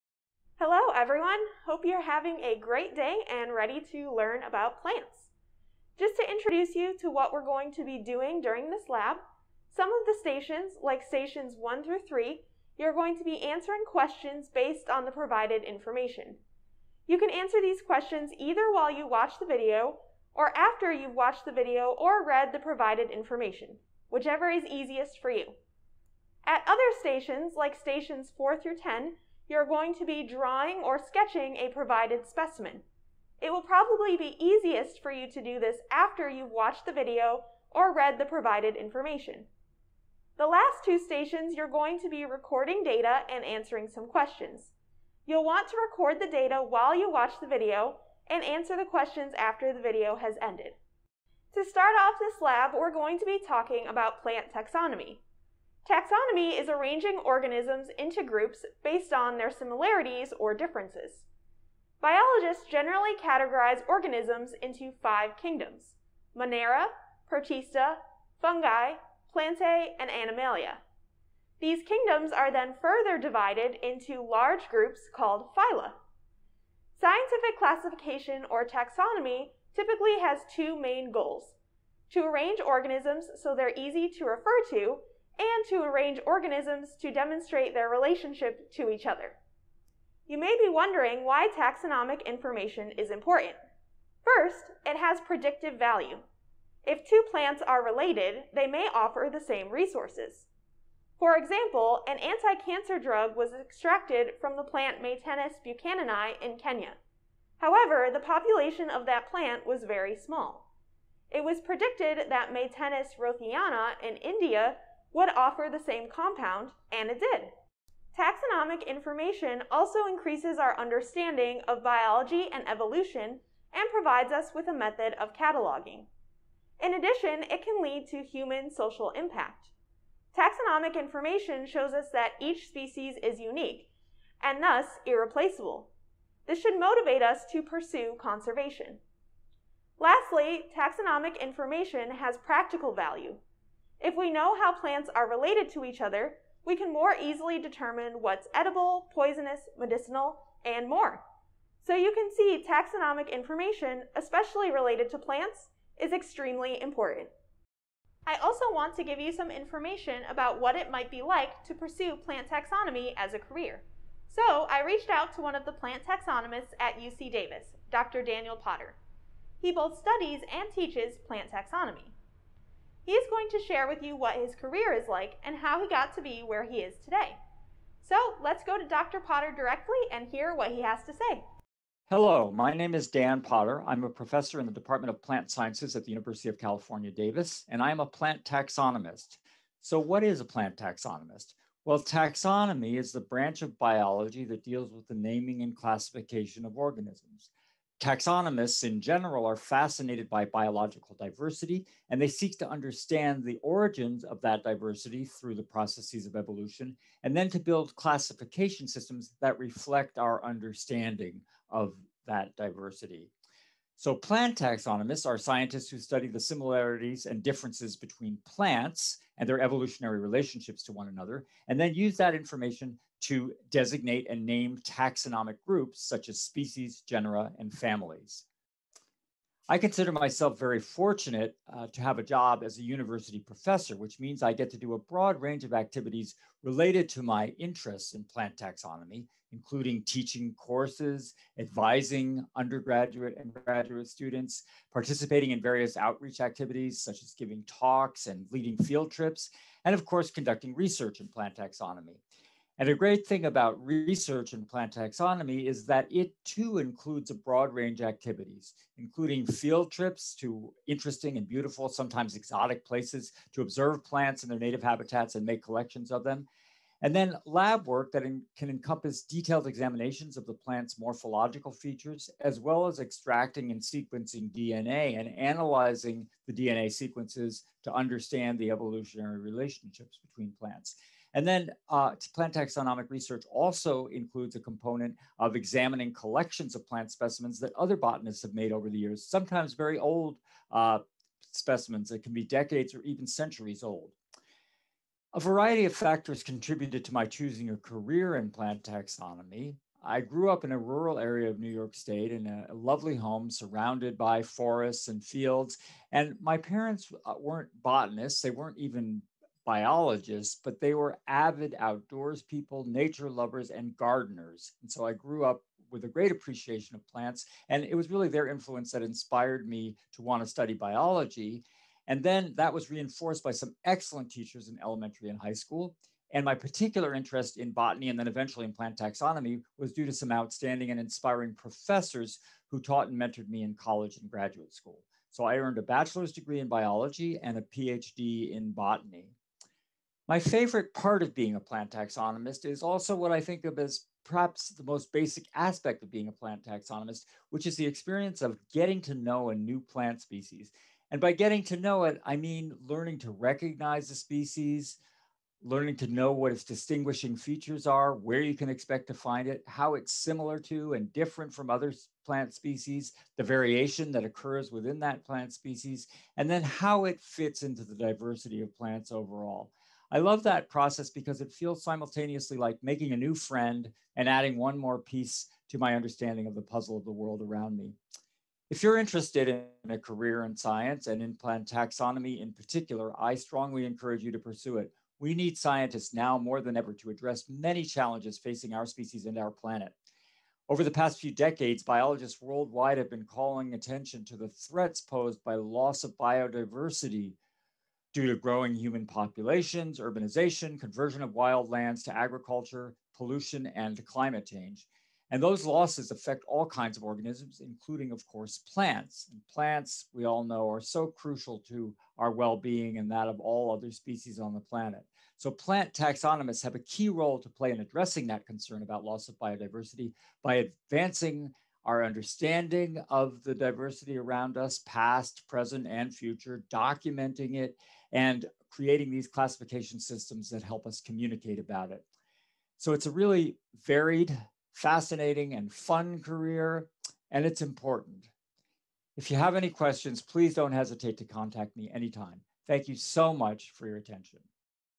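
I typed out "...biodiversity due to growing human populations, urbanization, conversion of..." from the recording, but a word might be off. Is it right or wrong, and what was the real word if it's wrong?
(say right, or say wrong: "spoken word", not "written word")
right.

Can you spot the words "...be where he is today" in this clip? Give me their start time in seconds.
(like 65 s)
176 s.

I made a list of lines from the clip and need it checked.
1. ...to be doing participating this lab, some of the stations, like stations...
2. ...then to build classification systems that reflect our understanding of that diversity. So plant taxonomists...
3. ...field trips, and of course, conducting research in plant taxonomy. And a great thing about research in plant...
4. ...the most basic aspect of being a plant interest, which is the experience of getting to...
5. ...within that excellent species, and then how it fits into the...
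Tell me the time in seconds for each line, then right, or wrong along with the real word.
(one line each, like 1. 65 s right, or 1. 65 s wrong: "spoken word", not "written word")
1. 7 s wrong: "during", not "participating"
2. 207 s right
3. 248 s right
4. 344 s wrong: "taxonomist", not "interest"
5. 364 s wrong: "plant", not "excellent".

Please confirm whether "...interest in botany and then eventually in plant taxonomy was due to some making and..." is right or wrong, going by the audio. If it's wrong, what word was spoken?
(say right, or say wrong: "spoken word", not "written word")
wrong: "outstanding", not "making".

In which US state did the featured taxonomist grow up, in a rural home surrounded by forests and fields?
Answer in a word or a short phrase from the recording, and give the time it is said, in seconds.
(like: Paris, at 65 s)
New York, at 301 s.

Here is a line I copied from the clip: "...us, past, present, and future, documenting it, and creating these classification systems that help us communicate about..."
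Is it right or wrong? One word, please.
right.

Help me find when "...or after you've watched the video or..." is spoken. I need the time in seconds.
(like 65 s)
20 s.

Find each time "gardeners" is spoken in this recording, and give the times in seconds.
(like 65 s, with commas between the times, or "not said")
313 s.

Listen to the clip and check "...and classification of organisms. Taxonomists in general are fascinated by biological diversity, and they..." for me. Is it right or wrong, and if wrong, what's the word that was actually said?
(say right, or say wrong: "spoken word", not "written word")
right.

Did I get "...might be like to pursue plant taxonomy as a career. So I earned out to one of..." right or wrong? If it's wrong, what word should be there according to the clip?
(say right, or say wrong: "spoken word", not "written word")
wrong: "reached", not "earned".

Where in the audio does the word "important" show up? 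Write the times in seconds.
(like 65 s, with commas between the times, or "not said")
93 s, 156 s, 437 s.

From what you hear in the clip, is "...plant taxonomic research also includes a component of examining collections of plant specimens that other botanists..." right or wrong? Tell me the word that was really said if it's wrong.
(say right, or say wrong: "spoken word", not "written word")
right.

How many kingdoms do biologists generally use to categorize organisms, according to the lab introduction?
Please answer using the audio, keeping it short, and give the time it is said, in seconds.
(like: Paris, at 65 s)
5, at 65 s.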